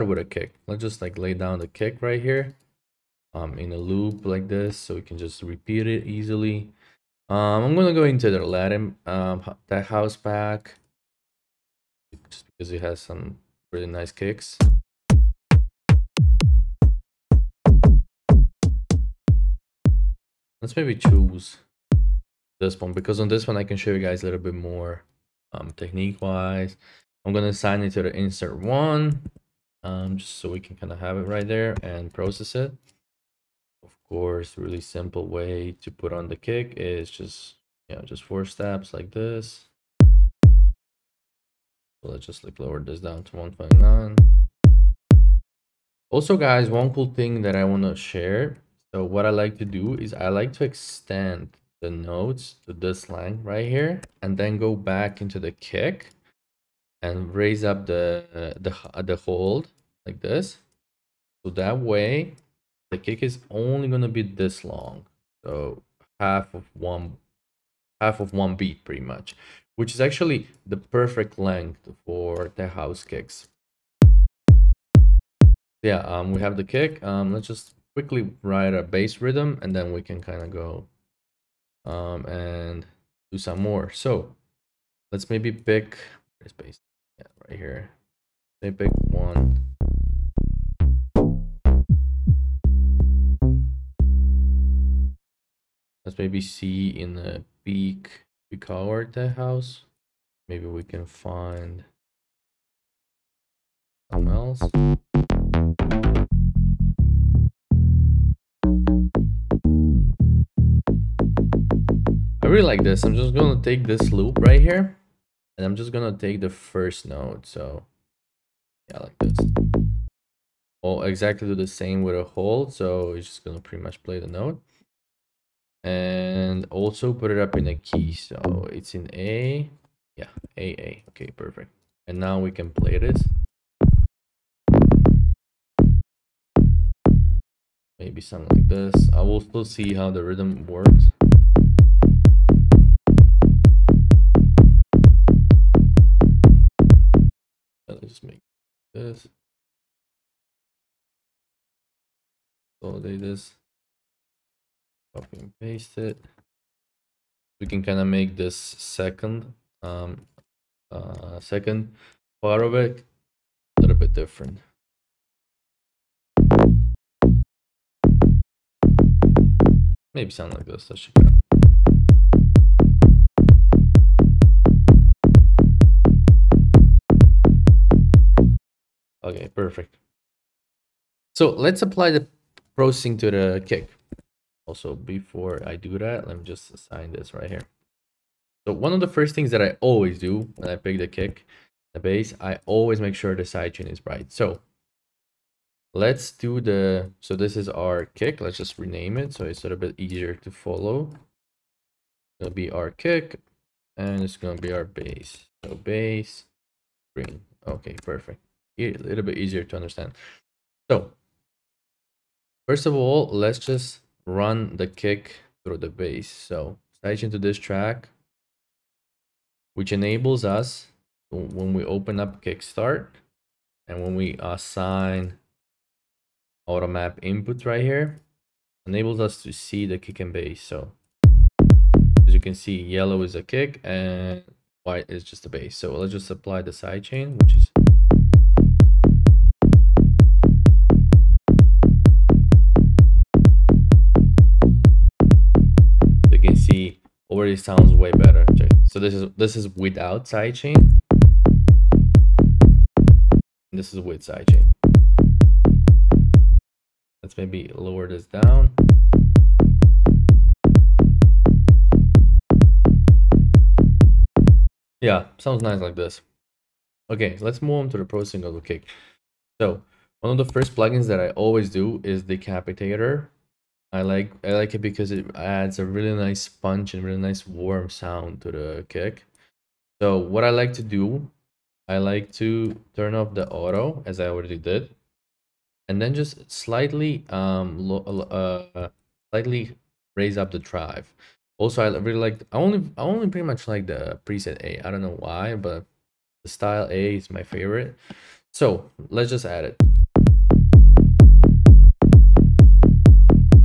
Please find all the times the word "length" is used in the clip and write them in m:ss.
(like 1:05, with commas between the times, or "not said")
1:11.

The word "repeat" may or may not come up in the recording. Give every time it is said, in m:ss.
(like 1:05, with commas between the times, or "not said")
0:05.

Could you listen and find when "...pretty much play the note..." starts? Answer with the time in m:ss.
2:03.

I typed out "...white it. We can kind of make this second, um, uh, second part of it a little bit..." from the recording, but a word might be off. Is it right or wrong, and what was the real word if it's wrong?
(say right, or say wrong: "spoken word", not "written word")
wrong: "paste", not "white".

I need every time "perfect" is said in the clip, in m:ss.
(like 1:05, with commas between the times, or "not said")
1:10, 2:11, 2:59, 3:28.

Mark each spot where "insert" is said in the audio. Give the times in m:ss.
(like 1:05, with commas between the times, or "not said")
0:28.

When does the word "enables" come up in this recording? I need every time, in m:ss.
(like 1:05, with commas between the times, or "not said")
3:39, 3:48.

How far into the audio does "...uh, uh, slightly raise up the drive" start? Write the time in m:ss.
4:47.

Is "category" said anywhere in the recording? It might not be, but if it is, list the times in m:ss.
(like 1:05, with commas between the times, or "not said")
not said.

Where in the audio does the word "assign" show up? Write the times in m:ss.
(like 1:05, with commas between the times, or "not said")
0:27, 3:06, 3:44.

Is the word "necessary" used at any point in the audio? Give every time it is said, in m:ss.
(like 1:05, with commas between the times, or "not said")
not said.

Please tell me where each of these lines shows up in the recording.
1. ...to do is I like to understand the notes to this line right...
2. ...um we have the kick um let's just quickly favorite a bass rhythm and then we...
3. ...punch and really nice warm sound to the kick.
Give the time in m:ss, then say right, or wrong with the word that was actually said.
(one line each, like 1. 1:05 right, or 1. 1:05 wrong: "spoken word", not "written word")
1. 0:49 wrong: "extend", not "understand"
2. 1:16 wrong: "write", not "favorite"
3. 4:36 right.